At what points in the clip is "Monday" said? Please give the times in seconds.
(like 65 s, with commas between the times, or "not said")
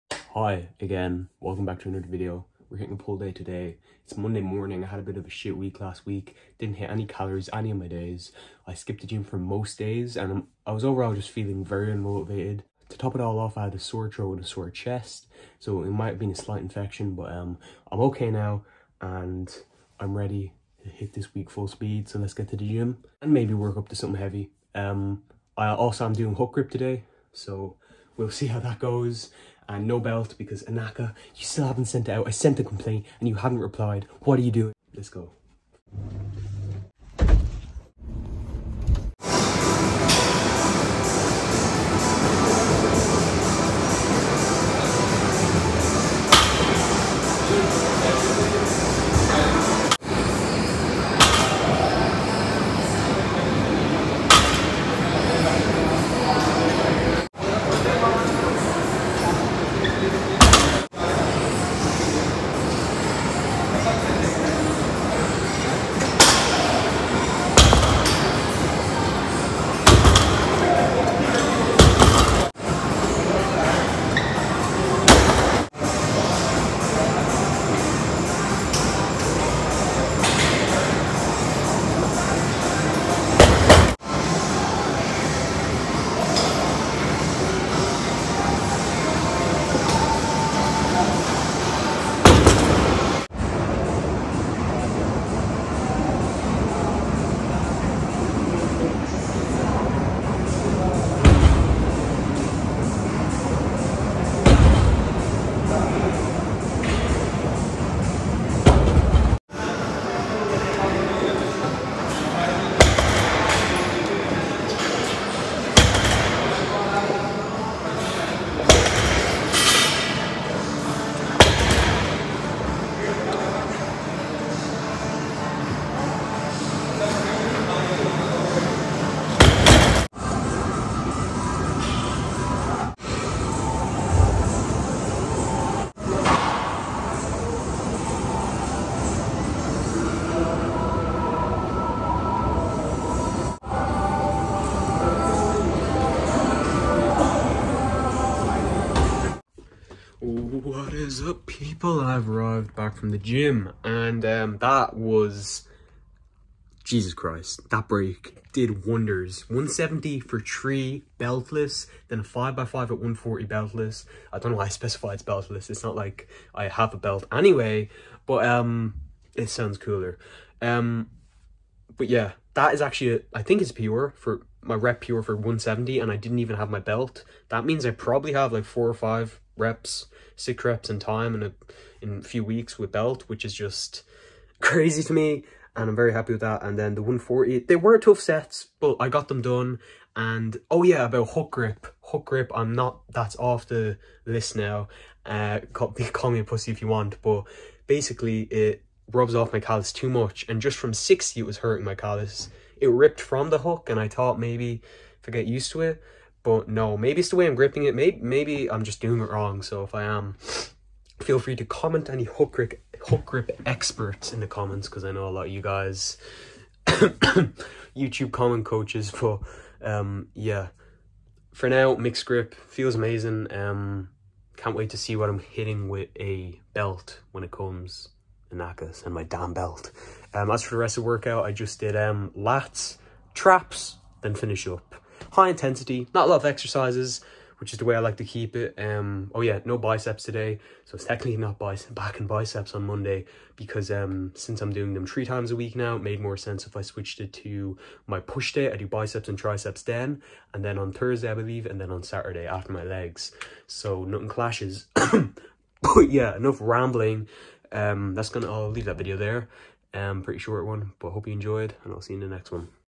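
4 s, 242 s.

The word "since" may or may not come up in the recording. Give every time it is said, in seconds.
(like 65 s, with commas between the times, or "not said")
244 s.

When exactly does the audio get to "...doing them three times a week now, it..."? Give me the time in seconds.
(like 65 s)
244 s.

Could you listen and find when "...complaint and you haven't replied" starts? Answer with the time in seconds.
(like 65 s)
32 s.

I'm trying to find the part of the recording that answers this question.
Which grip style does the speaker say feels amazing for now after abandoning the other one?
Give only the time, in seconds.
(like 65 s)
221 s.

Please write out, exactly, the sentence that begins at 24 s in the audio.
Um, I also am doing hook grip today.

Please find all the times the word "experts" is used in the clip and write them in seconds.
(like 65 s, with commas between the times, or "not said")
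213 s.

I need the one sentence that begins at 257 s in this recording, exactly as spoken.
Um, that's gonna, I'll leave that video there.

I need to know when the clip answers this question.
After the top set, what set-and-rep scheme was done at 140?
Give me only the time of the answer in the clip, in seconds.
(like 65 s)
162 s.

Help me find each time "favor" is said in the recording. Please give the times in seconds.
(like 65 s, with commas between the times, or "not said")
not said.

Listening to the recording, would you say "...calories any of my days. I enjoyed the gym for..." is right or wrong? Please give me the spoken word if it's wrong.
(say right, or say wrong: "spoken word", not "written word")
wrong: "skipped", not "enjoyed".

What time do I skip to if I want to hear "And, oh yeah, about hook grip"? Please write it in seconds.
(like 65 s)
190 s.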